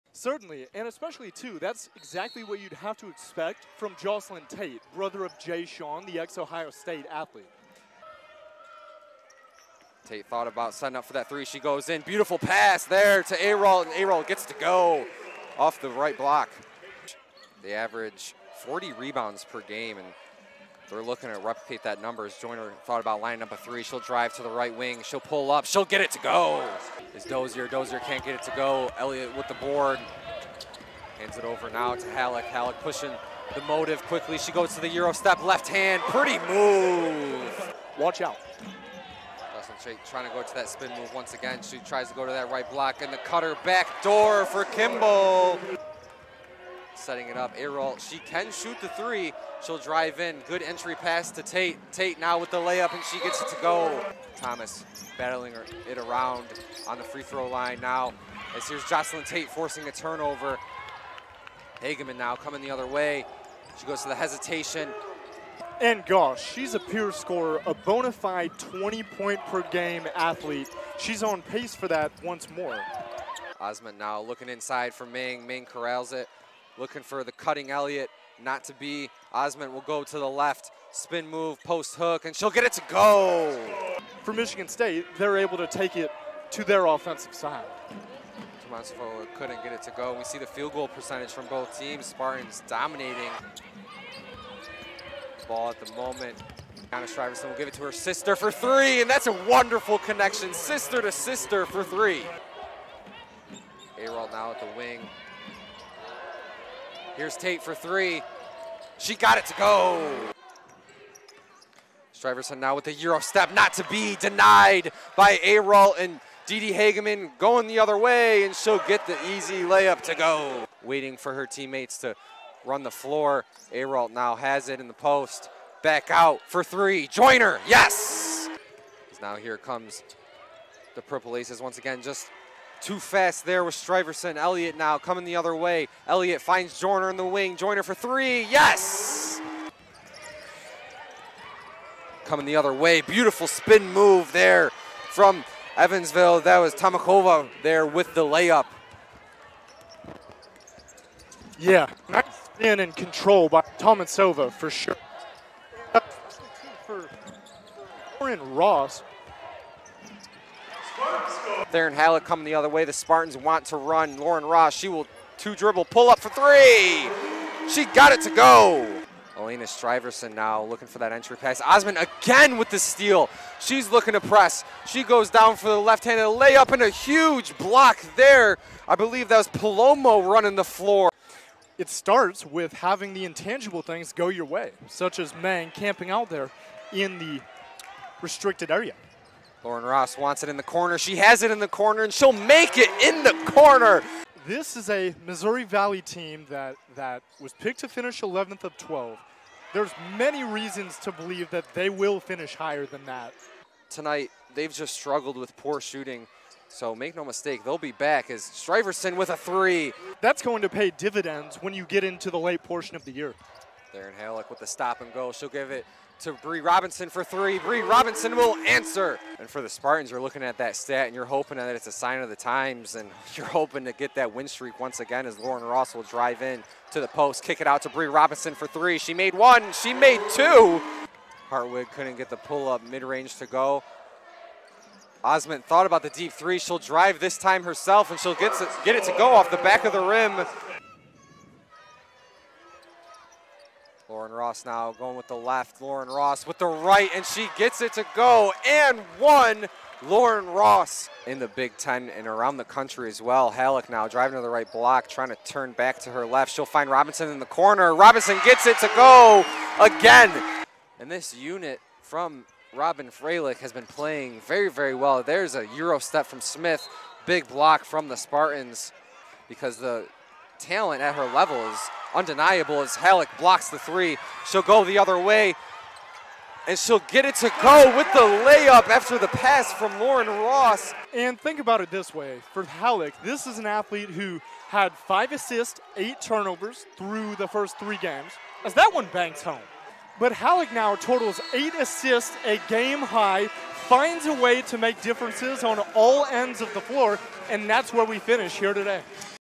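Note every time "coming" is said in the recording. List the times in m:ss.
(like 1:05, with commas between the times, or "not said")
1:02, 2:14, 2:22, 2:42.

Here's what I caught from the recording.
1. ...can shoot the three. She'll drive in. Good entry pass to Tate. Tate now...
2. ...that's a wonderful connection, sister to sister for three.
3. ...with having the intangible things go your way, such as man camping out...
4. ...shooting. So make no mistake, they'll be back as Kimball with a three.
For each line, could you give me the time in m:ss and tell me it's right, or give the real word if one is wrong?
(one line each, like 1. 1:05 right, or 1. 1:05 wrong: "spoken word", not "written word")
1. 0:48 right
2. 1:39 right
3. 3:02 right
4. 3:25 wrong: "Striverson", not "Kimball".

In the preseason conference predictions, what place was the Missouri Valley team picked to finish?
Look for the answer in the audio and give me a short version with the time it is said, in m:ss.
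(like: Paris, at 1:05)
11th of 12, at 3:18.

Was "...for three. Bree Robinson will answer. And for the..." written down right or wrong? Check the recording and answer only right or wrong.
right.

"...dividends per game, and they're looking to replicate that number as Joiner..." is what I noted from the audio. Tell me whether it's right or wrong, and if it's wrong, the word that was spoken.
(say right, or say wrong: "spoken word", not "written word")
wrong: "rebounds", not "dividends".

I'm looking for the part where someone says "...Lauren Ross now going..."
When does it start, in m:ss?
4:04.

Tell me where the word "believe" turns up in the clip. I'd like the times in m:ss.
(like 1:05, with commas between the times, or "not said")
2:58, 3:21.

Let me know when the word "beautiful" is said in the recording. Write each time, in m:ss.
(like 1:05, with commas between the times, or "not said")
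0:12, 2:23.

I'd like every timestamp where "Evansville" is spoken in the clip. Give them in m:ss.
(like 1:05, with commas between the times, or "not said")
2:25.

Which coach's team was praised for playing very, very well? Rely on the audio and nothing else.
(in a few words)
Robyn Fralick.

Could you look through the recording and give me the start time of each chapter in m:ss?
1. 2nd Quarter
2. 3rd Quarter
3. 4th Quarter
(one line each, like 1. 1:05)
1. 0:38
2. 1:50
3. 3:01.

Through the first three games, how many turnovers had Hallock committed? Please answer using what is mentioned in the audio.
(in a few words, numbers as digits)
8.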